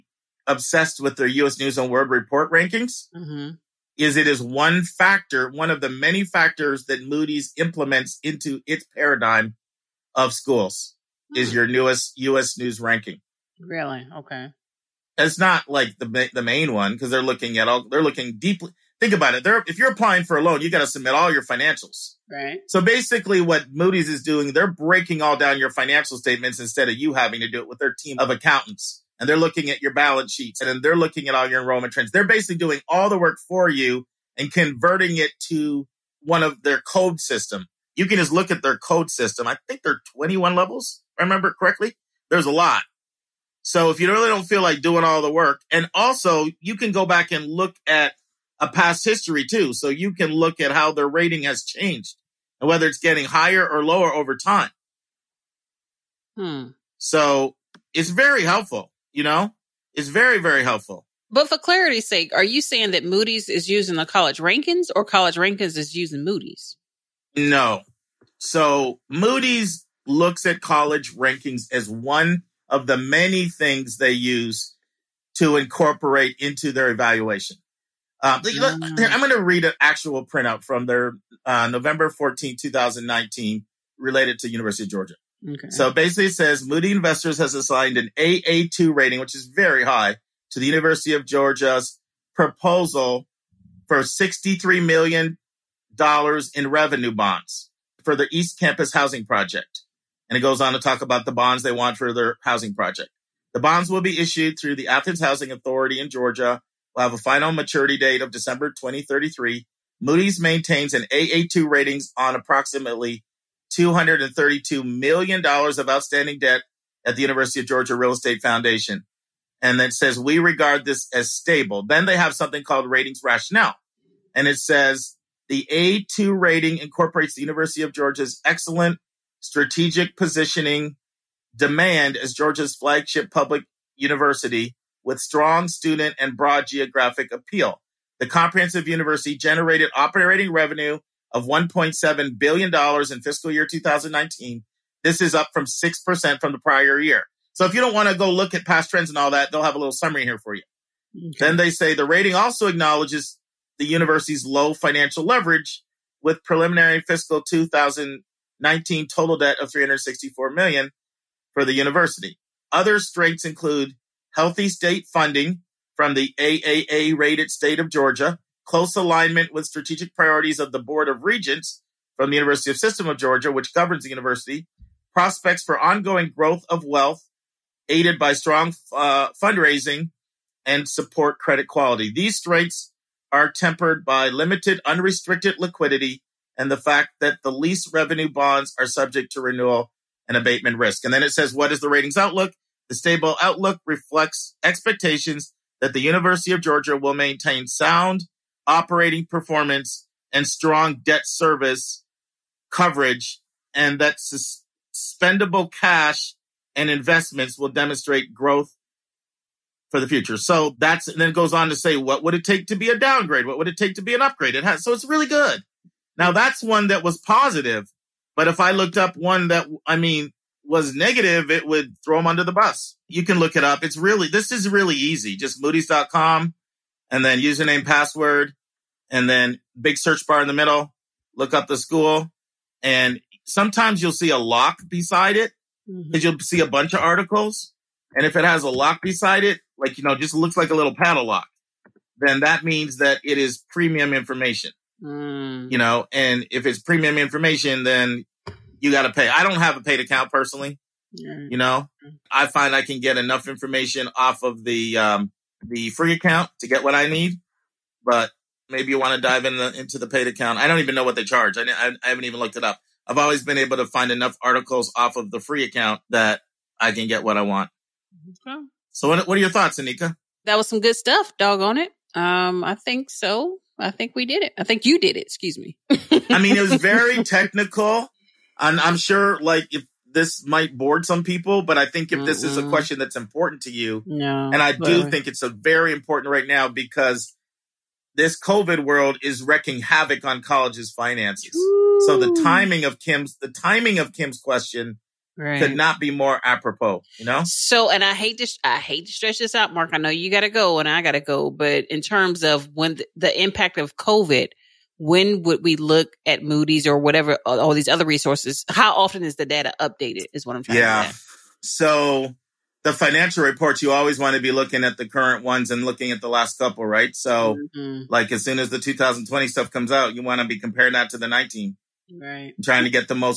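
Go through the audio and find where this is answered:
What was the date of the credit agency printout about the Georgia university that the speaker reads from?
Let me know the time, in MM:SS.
01:21.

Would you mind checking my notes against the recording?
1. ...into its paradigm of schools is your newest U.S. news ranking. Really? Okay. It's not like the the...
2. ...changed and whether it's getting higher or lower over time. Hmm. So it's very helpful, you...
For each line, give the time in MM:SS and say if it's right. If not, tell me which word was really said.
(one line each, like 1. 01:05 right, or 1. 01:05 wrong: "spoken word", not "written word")
1. 00:08 right
2. 00:51 right.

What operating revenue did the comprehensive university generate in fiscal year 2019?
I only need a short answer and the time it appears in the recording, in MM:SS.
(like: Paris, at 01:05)
$1.7 billion, at 02:21.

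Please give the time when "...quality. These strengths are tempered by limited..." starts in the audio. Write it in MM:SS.
03:01.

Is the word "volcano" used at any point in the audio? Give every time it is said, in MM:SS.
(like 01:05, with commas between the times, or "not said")
not said.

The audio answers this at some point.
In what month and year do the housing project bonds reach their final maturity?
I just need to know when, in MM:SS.
01:48.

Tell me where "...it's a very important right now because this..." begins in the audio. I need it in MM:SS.
04:45.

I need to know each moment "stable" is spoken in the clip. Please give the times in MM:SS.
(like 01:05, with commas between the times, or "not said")
02:01, 03:12.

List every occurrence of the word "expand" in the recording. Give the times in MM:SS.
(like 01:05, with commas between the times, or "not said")
not said.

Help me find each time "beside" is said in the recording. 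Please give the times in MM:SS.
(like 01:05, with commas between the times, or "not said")
03:54, 03:59.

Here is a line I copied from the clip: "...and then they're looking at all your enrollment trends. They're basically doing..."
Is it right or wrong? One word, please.
right.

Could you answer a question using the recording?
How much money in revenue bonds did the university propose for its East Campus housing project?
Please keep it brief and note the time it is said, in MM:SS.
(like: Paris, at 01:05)
$63 million, at 01:33.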